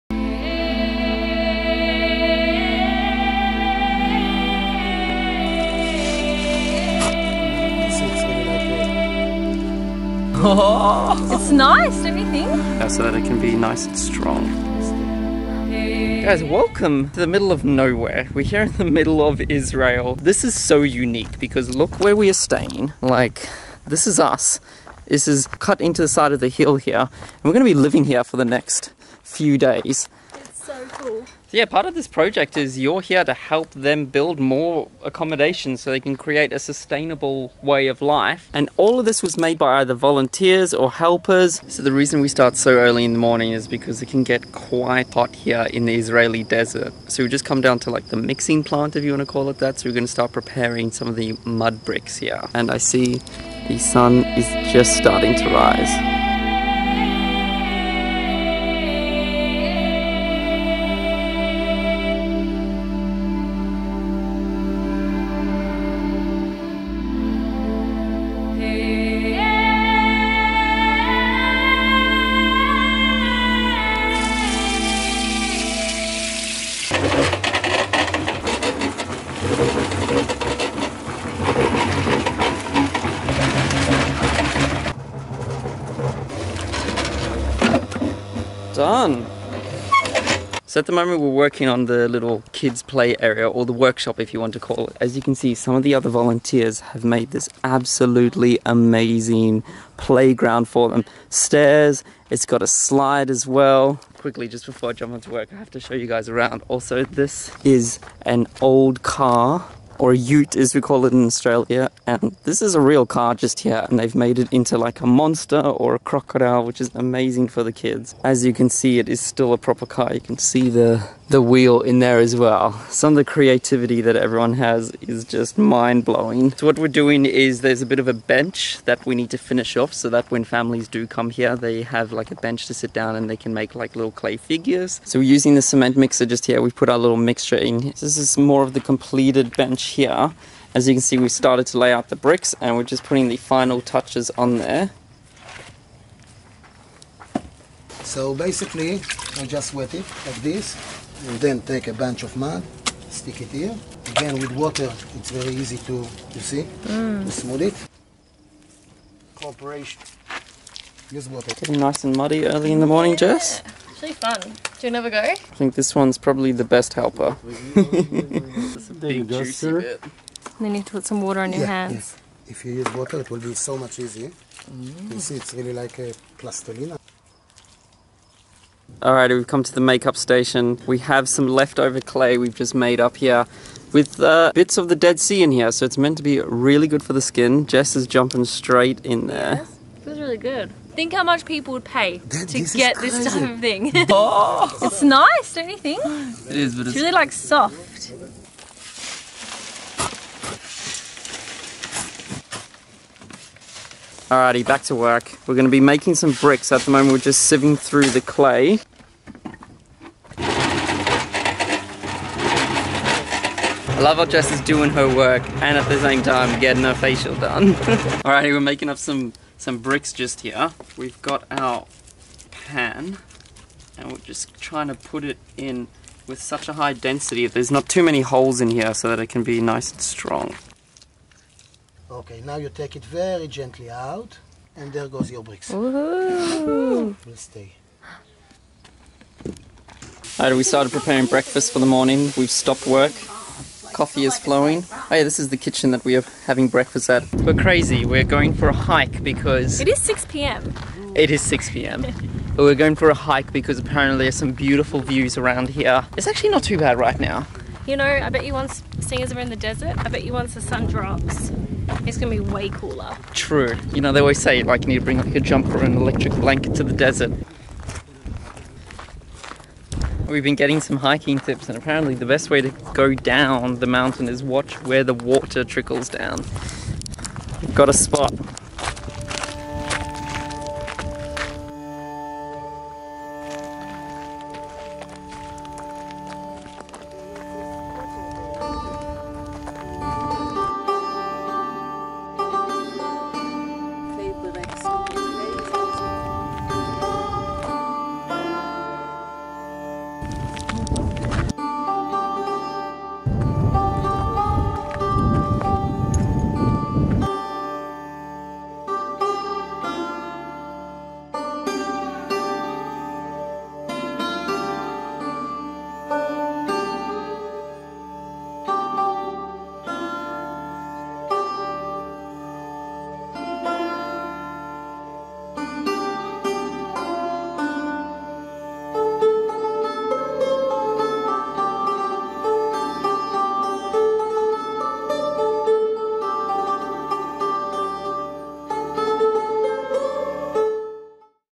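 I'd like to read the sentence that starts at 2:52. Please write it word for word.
If you use water, it will be so much easier.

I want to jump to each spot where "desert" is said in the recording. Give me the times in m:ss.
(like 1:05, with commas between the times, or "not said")
0:46, 4:19, 4:26.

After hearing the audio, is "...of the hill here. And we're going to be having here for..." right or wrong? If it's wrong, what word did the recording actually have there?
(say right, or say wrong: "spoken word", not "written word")
wrong: "living", not "having".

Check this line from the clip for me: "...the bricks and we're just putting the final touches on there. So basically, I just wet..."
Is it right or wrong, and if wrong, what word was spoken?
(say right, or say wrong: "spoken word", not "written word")
right.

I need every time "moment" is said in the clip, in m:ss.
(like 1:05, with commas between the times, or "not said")
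1:30, 3:26.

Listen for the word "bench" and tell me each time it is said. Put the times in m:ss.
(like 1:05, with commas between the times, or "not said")
2:08, 2:12, 2:19.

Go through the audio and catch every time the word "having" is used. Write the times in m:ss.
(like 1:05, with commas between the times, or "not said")
4:06.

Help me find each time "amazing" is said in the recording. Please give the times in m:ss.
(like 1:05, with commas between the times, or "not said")
1:38, 1:56.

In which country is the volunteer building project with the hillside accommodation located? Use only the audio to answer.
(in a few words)
Israel.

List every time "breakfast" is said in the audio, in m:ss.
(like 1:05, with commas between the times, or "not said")
4:01, 4:06.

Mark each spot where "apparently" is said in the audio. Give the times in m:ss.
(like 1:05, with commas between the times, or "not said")
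4:13, 4:31.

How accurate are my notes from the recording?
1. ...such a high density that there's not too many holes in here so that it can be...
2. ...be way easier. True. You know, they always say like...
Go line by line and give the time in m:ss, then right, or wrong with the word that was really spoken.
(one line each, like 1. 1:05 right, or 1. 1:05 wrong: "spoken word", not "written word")
1. 3:46 right
2. 4:22 wrong: "cooler", not "easier".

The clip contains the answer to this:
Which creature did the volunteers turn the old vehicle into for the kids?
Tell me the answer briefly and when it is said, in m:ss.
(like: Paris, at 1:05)
crocodile, at 1:55.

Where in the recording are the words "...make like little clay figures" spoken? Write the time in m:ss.
2:13.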